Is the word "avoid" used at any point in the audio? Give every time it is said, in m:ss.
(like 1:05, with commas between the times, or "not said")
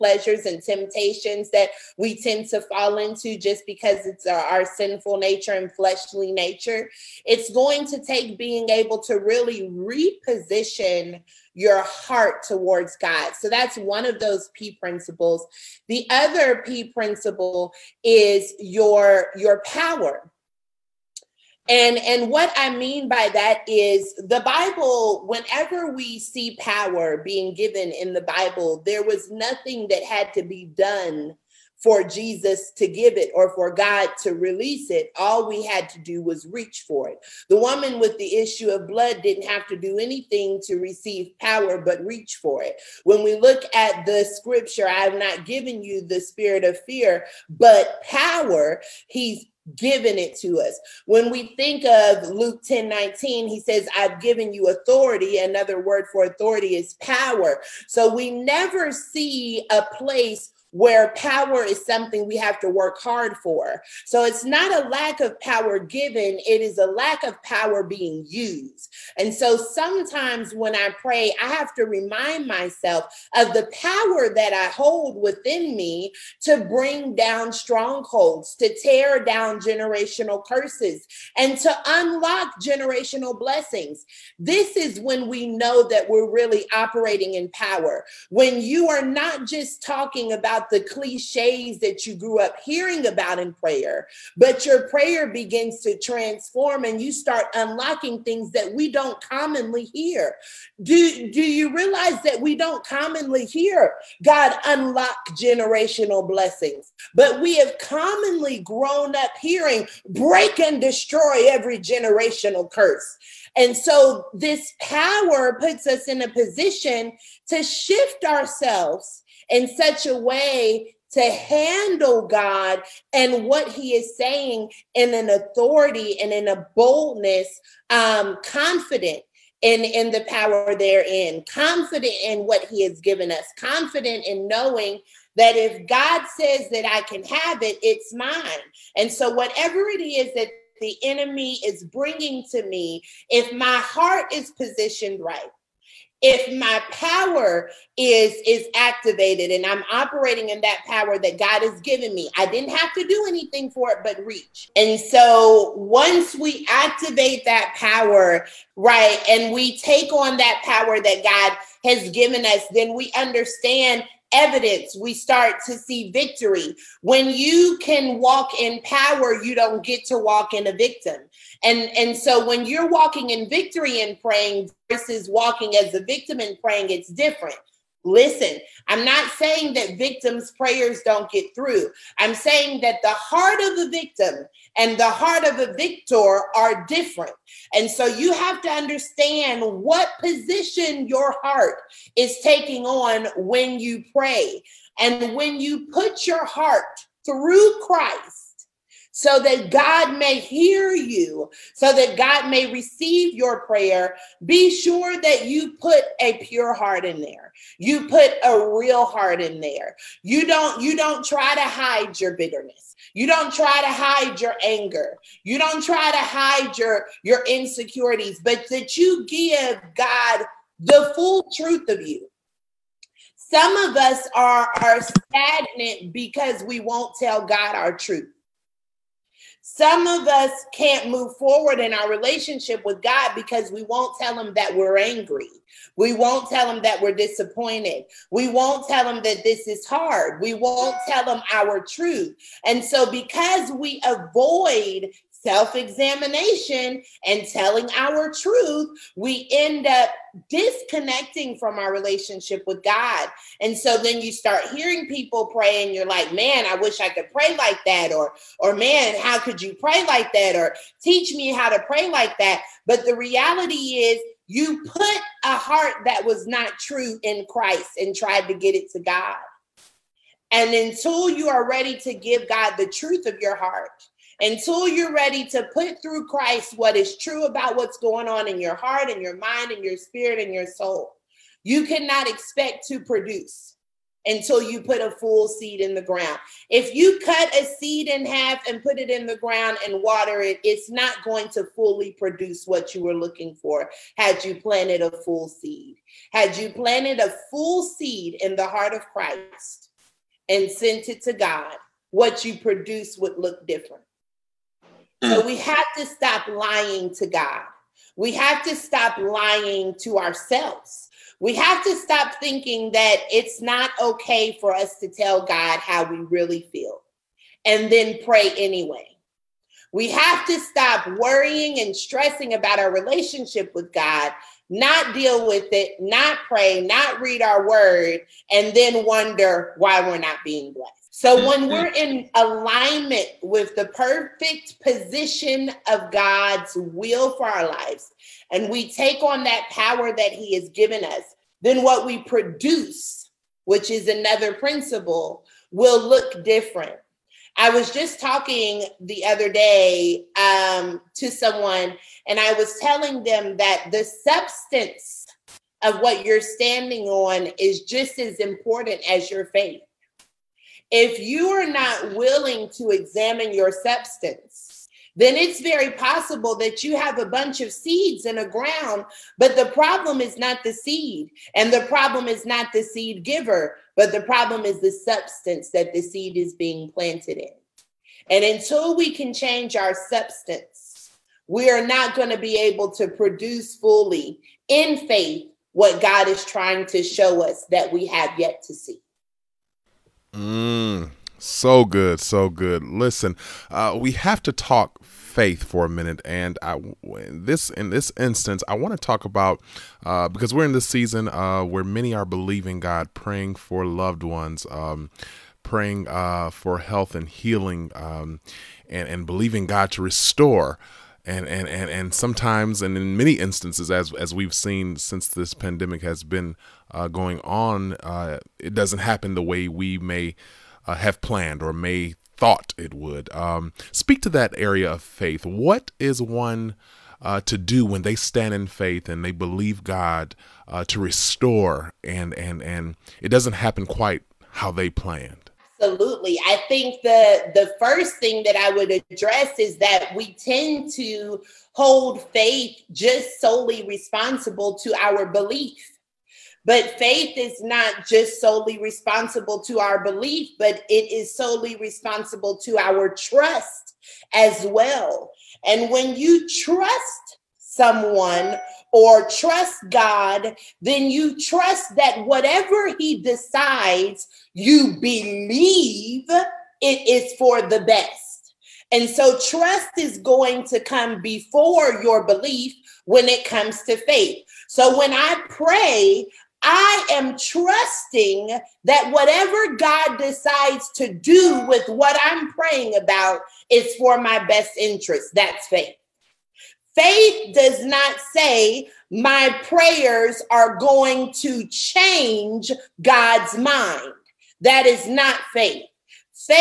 4:04.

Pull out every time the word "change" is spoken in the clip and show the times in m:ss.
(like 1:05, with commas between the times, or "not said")
6:19, 8:11.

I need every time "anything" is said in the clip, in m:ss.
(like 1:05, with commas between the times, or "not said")
0:39, 2:33.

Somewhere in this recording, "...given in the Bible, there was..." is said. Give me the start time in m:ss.
0:27.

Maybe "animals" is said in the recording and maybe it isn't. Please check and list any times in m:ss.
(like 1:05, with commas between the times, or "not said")
not said.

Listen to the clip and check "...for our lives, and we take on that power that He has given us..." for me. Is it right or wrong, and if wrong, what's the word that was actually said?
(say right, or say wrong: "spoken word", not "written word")
right.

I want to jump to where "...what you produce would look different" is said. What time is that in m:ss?
5:02.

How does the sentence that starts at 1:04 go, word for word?
So it's not a lack of power given, it is a lack of power being used.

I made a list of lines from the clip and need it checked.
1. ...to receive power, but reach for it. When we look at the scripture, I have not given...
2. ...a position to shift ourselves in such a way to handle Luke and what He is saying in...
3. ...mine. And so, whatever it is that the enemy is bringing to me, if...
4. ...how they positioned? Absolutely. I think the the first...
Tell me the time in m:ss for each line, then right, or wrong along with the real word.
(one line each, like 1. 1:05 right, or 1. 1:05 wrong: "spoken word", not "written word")
1. 0:40 right
2. 1:56 wrong: "God", not "Luke"
3. 2:18 right
4. 7:14 wrong: "planned", not "positioned".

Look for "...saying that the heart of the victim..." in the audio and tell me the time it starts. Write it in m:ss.
3:02.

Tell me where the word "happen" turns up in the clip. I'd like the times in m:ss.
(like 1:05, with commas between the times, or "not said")
6:58, 7:13.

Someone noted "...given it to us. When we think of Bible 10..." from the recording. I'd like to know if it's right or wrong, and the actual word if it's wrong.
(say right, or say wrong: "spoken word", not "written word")
wrong: "Luke", not "Bible".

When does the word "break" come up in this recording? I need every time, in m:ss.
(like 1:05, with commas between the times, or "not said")
1:50.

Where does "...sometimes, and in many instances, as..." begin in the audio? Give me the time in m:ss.
6:52.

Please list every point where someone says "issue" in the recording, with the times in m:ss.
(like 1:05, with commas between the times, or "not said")
0:38.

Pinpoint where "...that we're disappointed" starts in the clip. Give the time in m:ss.
3:56.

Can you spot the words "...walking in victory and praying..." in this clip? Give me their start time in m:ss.
2:52.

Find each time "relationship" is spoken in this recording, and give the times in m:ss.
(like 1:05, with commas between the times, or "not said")
3:52, 4:11, 5:22.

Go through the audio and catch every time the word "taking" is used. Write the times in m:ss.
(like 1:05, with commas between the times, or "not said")
3:12.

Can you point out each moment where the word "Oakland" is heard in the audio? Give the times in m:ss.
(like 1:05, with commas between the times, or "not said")
not said.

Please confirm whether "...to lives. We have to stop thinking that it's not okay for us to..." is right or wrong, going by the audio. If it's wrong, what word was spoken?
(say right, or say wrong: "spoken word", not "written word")
wrong: "ourselves", not "lives".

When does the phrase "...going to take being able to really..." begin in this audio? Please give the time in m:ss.
0:07.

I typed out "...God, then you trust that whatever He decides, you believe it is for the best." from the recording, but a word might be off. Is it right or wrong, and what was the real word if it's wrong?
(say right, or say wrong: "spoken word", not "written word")
right.